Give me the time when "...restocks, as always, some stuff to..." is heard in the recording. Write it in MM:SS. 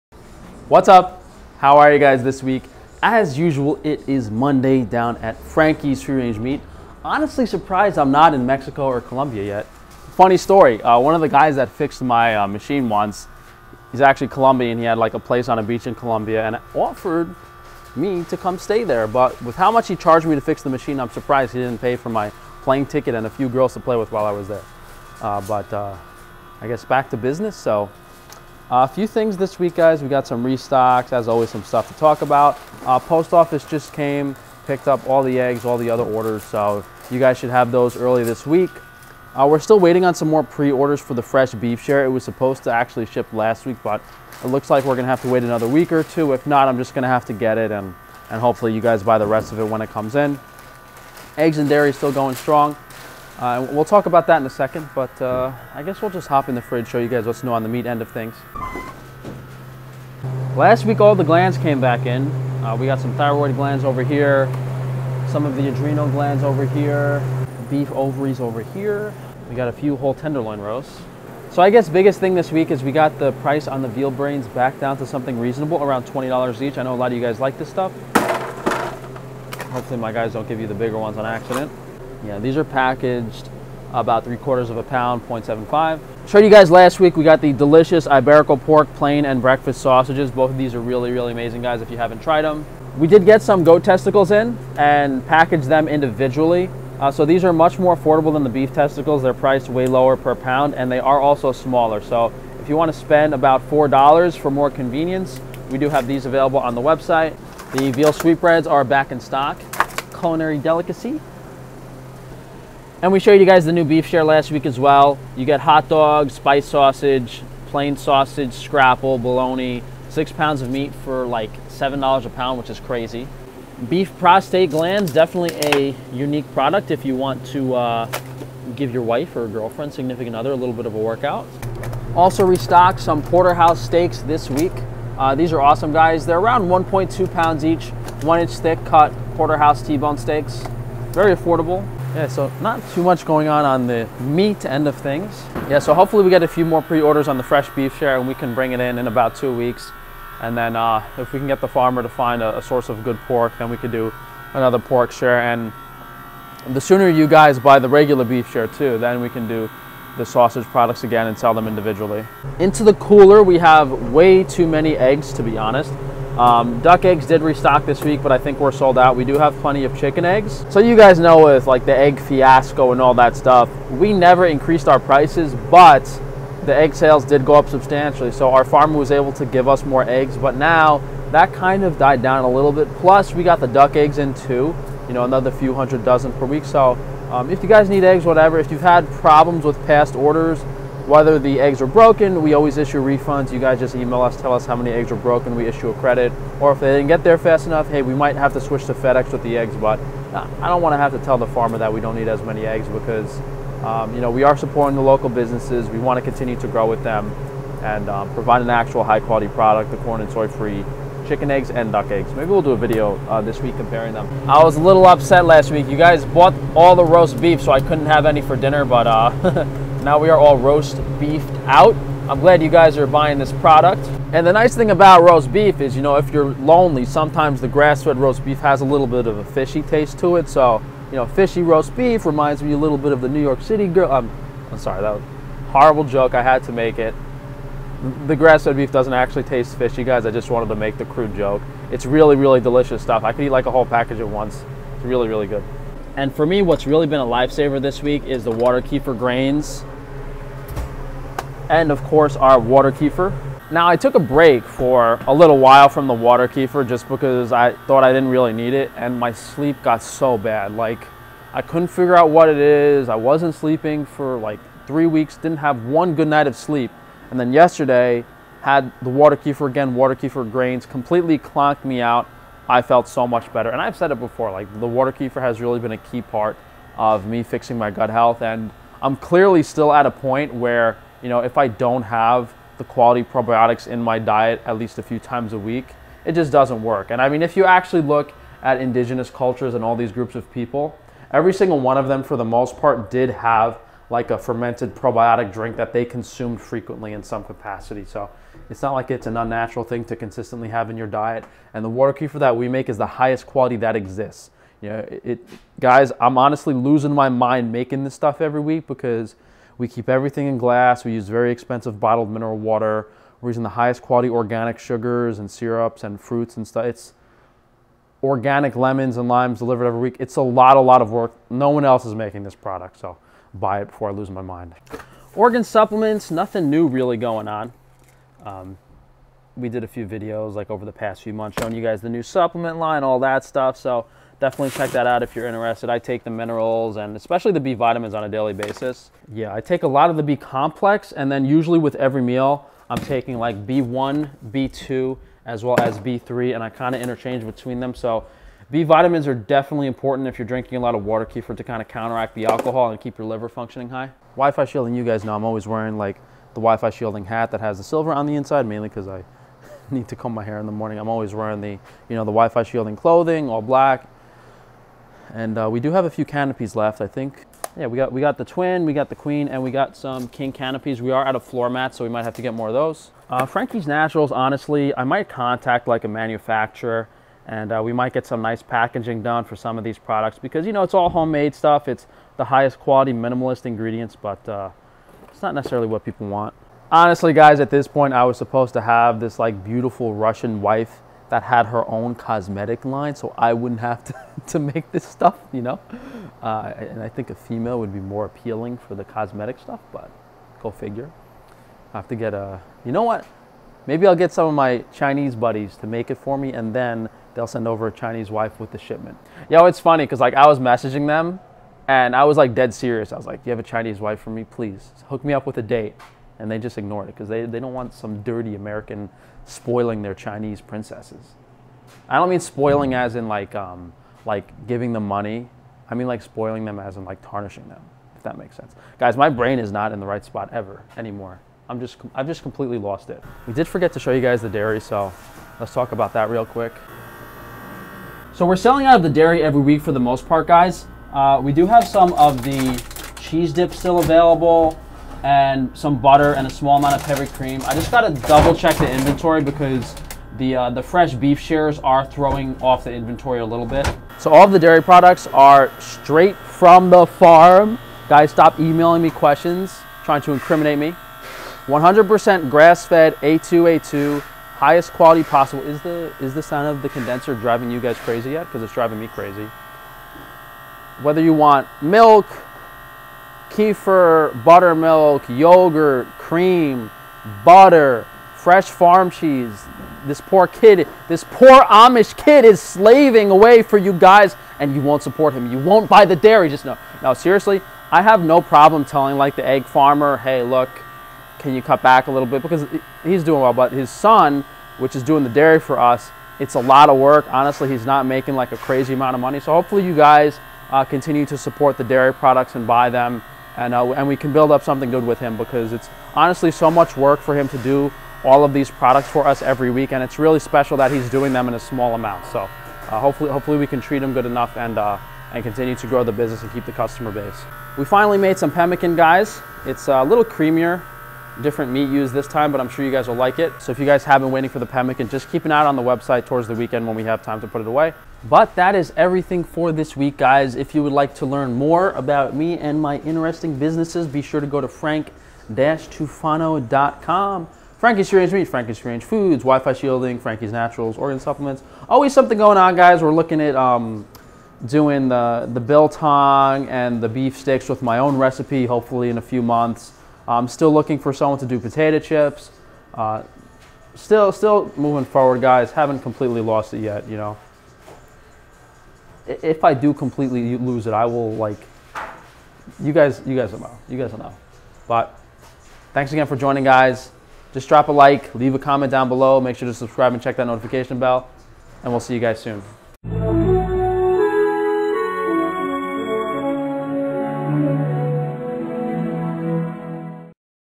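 00:30.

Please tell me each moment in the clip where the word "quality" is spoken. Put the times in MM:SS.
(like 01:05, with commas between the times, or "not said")
03:29, 04:42, 05:03, 05:14, 06:22, 07:44.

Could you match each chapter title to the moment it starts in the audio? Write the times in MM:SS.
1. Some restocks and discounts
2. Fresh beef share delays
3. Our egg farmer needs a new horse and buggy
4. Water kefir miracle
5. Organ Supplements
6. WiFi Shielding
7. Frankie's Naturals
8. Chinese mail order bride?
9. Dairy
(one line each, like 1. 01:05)
1. 00:58
2. 02:25
3. 02:42
4. 04:05
5. 05:24
6. 05:54
7. 06:13
8. 06:49
9. 07:18.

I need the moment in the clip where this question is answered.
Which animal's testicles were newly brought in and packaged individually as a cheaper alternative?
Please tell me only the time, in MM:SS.
01:33.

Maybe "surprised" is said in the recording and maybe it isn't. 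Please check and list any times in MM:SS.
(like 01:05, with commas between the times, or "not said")
00:07, 00:21.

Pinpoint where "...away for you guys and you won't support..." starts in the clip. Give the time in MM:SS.
08:03.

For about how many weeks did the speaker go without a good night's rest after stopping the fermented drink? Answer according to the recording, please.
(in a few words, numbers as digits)
3 weeks.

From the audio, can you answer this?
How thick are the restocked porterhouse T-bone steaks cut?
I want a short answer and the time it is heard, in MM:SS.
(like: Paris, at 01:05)
one inch, at 02:18.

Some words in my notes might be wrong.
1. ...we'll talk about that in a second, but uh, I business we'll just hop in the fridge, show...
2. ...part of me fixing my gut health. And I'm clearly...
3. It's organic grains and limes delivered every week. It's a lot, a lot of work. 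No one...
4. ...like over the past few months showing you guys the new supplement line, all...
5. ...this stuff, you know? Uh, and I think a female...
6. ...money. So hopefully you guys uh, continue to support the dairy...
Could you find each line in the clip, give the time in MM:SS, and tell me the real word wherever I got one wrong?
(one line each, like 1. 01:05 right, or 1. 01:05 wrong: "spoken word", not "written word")
1. 00:53 wrong: "guess", not "business"
2. 04:36 right
3. 05:16 wrong: "lemons", not "grains"
4. 05:30 right
5. 06:34 right
6. 08:19 right.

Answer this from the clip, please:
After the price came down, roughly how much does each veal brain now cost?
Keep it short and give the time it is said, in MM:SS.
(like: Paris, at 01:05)
$20, at 01:15.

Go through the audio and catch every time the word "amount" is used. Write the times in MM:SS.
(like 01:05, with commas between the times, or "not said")
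07:26, 08:18, 08:31.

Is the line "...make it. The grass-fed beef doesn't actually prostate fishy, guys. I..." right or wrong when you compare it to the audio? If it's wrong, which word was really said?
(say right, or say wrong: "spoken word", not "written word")
wrong: "taste", not "prostate".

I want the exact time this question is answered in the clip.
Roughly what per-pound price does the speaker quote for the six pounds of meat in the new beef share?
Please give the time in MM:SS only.
02:01.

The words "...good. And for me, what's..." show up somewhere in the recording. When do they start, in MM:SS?
04:05.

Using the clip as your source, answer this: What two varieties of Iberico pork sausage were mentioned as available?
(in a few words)
plain and breakfast.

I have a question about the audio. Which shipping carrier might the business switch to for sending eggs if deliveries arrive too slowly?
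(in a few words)
FedEx.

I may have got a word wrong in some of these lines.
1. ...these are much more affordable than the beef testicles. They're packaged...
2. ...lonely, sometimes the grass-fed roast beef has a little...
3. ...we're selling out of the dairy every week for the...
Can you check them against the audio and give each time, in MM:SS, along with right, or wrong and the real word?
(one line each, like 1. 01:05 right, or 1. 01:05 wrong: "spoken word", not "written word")
1. 01:37 wrong: "priced", not "packaged"
2. 03:46 right
3. 07:18 right.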